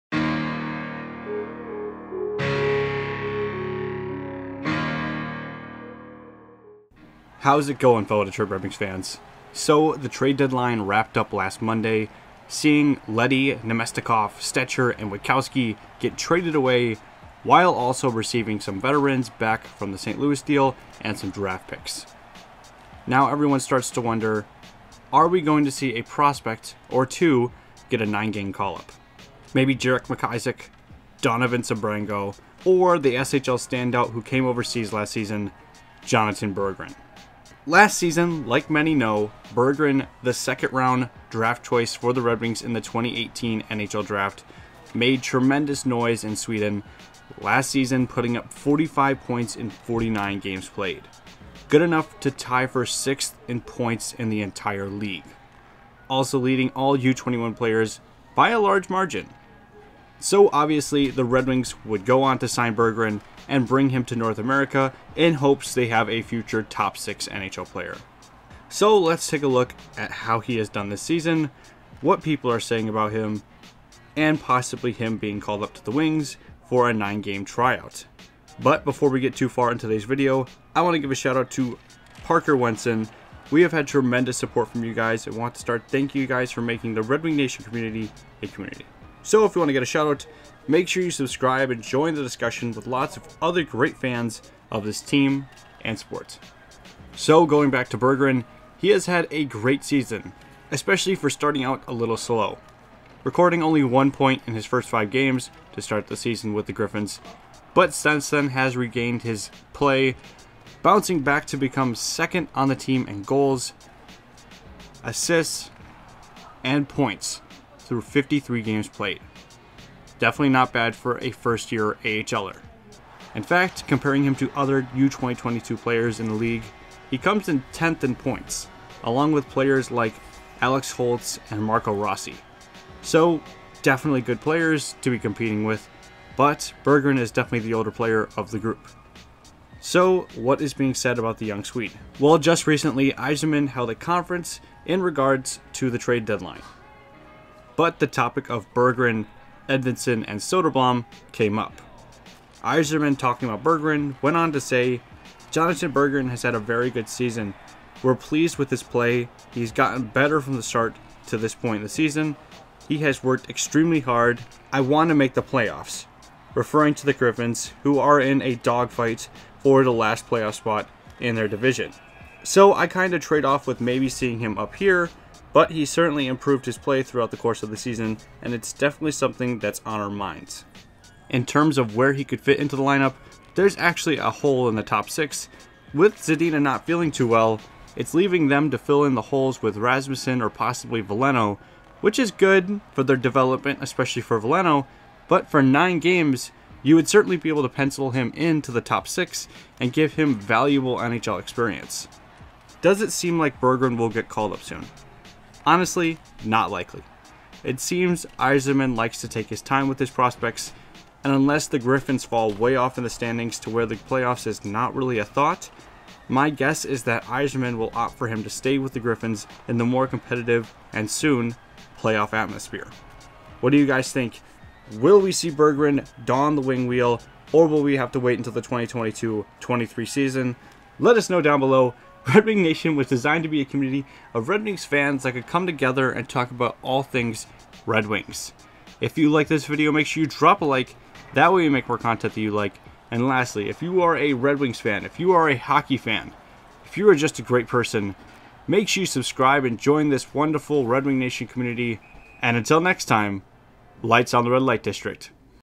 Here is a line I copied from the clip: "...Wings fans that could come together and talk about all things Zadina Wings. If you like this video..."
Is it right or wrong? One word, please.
wrong.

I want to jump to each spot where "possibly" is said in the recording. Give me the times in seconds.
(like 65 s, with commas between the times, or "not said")
74 s, 190 s.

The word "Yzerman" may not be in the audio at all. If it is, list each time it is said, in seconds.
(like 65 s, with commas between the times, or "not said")
143 s, 152 s, 208 s, 217 s.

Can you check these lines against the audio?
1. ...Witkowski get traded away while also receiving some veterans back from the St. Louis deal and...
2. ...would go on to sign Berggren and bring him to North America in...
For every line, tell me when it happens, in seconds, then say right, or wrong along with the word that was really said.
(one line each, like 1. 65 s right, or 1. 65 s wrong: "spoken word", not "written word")
1. 15 s right
2. 61 s right.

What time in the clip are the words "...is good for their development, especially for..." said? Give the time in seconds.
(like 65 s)
192 s.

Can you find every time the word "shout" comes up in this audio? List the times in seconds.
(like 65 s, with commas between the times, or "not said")
81 s, 89 s.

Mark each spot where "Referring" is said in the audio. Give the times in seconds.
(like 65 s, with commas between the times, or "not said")
166 s.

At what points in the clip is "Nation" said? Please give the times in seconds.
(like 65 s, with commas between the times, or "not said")
87 s, 232 s, 251 s.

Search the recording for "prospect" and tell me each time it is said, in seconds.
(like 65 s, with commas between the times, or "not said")
26 s, 210 s.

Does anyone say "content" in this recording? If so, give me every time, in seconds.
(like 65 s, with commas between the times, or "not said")
241 s.